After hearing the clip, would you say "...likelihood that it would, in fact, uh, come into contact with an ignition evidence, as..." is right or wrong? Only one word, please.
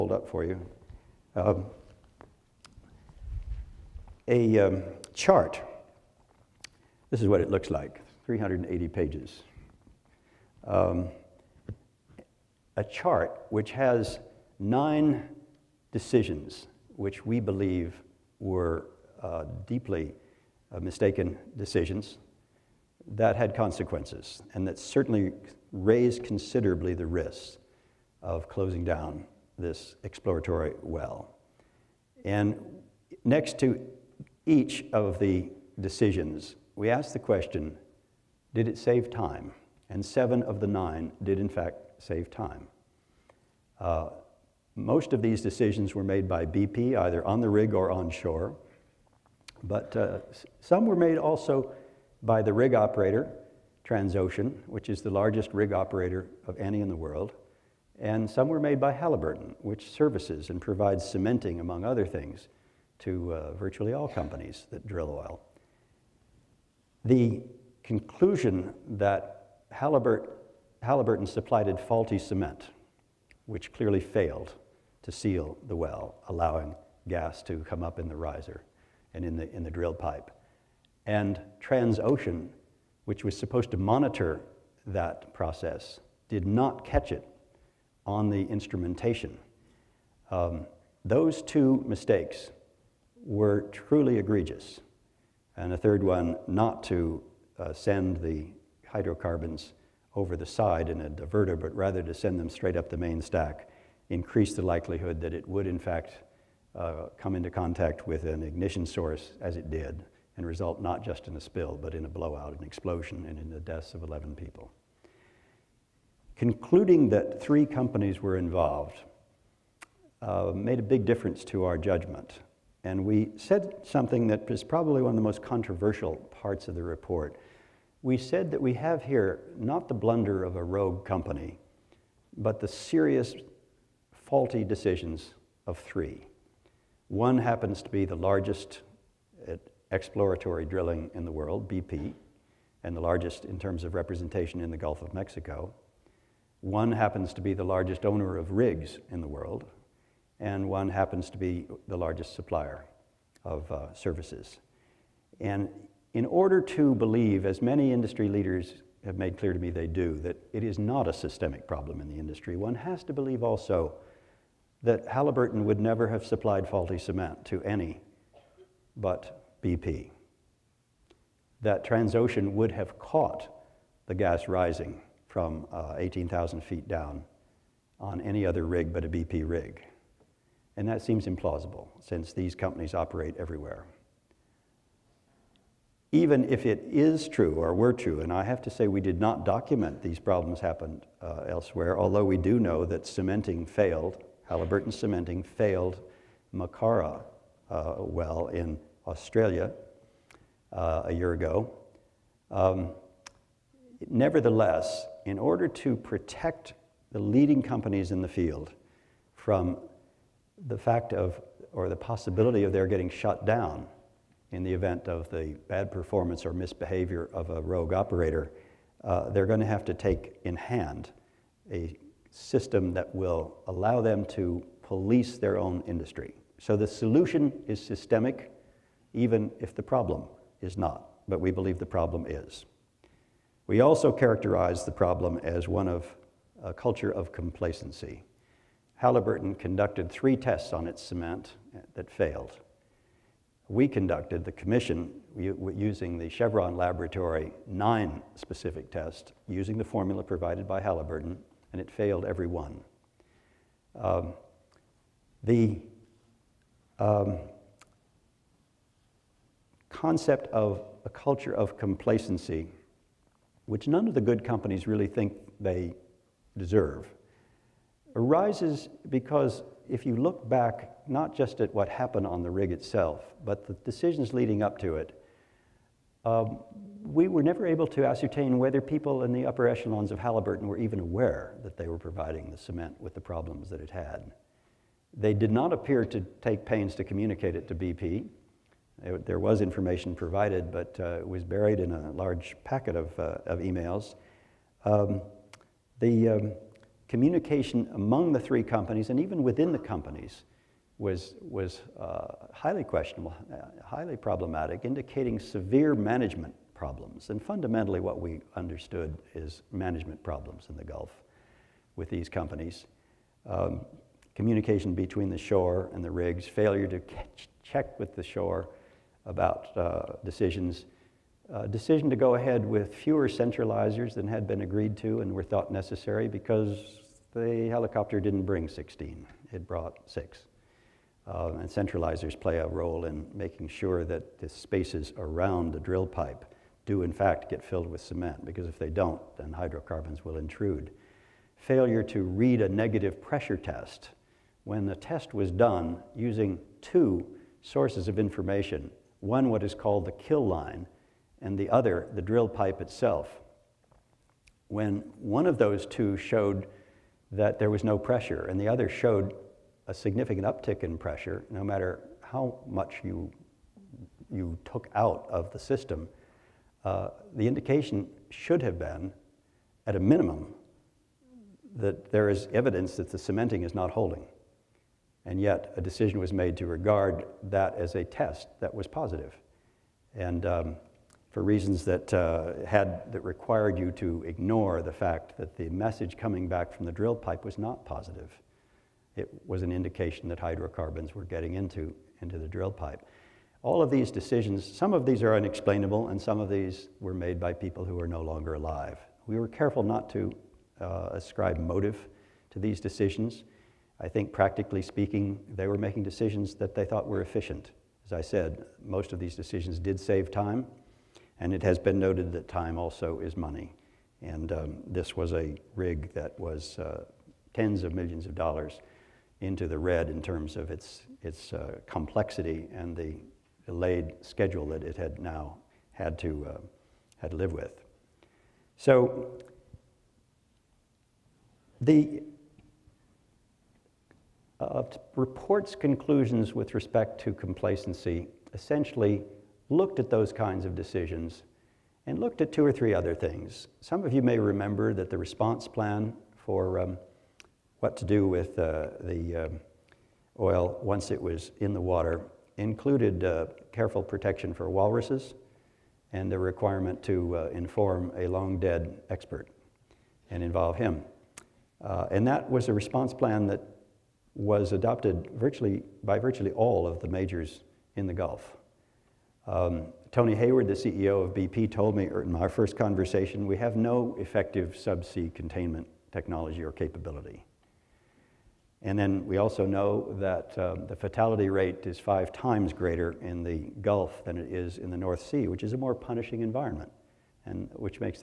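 wrong.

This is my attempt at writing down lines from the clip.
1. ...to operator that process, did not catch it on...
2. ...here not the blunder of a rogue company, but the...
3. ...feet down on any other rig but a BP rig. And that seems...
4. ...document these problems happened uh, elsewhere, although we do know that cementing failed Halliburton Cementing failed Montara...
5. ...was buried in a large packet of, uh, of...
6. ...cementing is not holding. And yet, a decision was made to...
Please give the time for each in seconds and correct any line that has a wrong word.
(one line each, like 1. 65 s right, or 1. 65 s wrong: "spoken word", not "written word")
1. 83 s wrong: "monitor", not "operator"
2. 129 s right
3. 176 s right
4. 189 s right
5. 291 s right
6. 373 s right.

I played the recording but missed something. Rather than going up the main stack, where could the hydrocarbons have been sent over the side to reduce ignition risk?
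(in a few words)
a diverter.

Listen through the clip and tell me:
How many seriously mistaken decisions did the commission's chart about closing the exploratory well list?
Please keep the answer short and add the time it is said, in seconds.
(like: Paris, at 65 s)
9, at 14 s.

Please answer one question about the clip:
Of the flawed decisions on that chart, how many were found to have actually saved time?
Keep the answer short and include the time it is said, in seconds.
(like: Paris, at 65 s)
7, at 40 s.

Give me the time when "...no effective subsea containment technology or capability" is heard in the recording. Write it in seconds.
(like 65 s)
473 s.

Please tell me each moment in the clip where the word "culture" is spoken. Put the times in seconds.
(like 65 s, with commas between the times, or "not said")
236 s, 261 s.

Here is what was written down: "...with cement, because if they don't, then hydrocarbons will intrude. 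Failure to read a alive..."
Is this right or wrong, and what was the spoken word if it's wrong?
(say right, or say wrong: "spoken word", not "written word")
wrong: "negative", not "alive".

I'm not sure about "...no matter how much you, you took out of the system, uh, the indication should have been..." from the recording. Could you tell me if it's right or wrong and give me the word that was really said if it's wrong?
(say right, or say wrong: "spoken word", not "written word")
right.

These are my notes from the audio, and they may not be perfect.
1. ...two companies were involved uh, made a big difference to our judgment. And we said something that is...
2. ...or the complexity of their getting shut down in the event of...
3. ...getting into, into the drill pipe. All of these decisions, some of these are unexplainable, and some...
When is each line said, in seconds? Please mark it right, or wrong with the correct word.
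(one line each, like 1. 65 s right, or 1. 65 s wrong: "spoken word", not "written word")
1. 117 s wrong: "three", not "two"
2. 211 s wrong: "possibility", not "complexity"
3. 391 s right.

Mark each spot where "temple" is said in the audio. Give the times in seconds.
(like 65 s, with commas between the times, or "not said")
not said.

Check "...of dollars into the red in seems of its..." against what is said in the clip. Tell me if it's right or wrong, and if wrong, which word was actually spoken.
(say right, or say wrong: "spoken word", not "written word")
wrong: "terms", not "seems".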